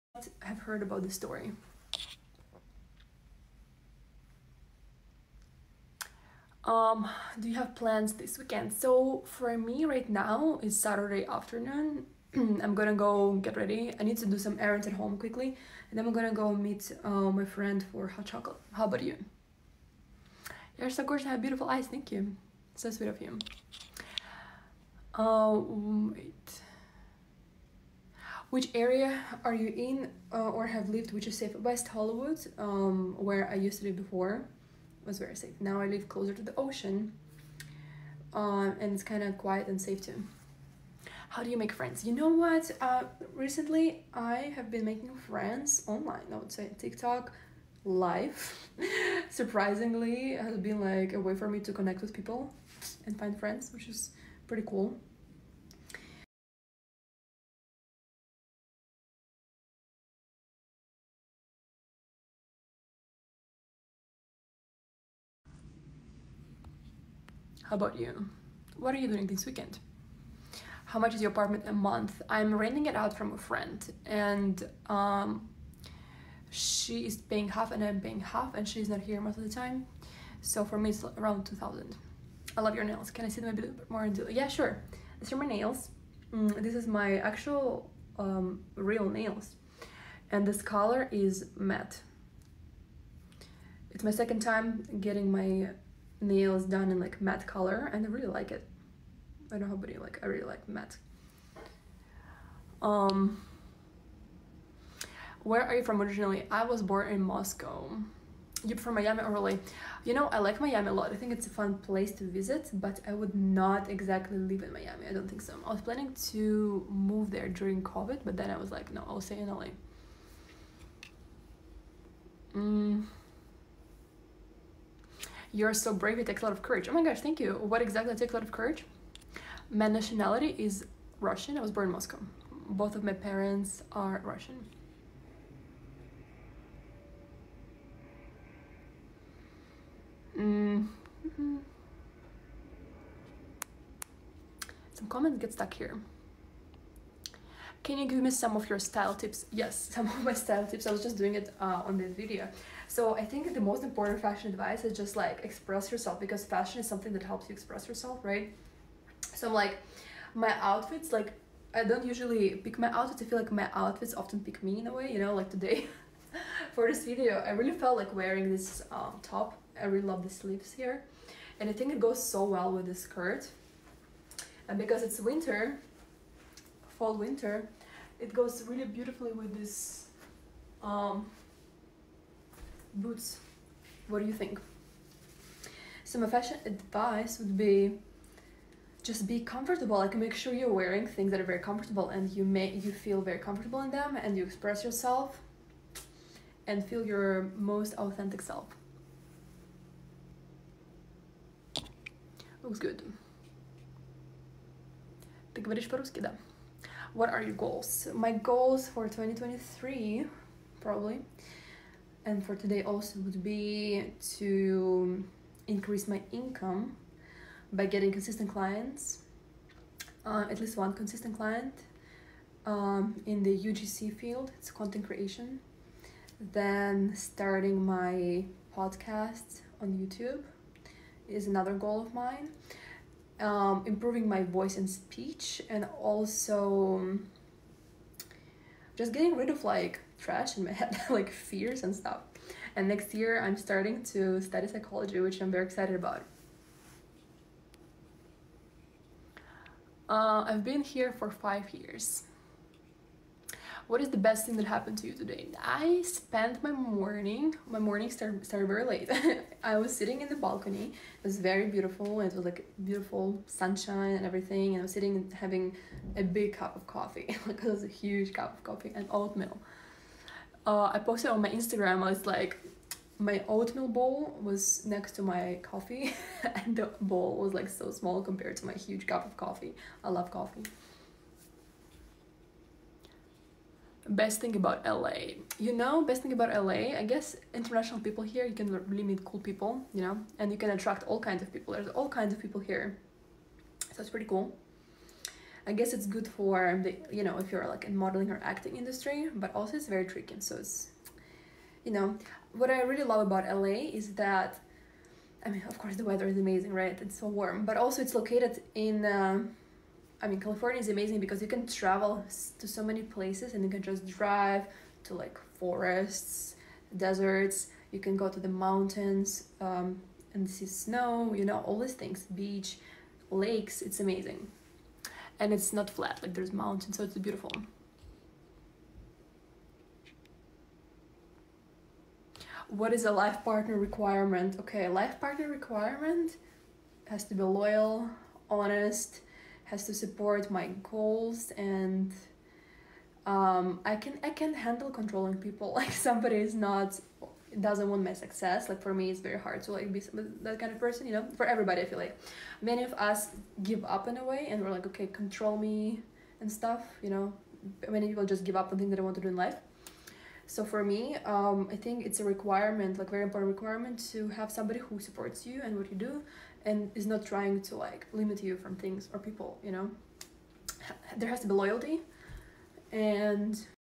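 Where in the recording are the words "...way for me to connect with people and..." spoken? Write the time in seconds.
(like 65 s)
51 s.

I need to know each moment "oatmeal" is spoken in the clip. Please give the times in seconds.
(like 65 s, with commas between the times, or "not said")
269 s, 273 s.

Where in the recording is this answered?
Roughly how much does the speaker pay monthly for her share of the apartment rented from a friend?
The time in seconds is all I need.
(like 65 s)
81 s.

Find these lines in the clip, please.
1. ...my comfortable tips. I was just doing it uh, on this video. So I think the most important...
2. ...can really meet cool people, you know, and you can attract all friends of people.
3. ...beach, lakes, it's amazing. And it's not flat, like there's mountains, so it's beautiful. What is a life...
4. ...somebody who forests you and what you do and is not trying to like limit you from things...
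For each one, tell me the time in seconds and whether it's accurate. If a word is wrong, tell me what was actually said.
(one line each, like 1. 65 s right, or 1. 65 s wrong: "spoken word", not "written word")
1. 150 s wrong: "style", not "comfortable"
2. 288 s wrong: "kinds", not "friends"
3. 322 s right
4. 364 s wrong: "supports", not "forests".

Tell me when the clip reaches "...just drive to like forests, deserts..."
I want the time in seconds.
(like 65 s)
313 s.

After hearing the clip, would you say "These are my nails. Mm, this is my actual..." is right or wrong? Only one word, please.
right.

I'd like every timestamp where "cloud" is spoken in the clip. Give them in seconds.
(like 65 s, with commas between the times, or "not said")
not said.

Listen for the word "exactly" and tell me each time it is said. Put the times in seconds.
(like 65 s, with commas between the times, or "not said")
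113 s, 127 s.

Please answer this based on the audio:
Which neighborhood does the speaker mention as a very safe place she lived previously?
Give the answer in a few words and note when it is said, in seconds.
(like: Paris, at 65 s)
West Hollywood, at 31 s.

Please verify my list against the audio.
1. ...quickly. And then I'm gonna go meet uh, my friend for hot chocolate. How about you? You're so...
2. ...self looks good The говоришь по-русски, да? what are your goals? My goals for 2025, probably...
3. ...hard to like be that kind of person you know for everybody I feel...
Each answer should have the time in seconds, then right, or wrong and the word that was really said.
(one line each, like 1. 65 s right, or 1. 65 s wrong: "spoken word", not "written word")
1. 15 s right
2. 198 s wrong: "2023", not "2025"
3. 349 s right.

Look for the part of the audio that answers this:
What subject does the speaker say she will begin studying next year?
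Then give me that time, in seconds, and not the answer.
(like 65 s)
244 s.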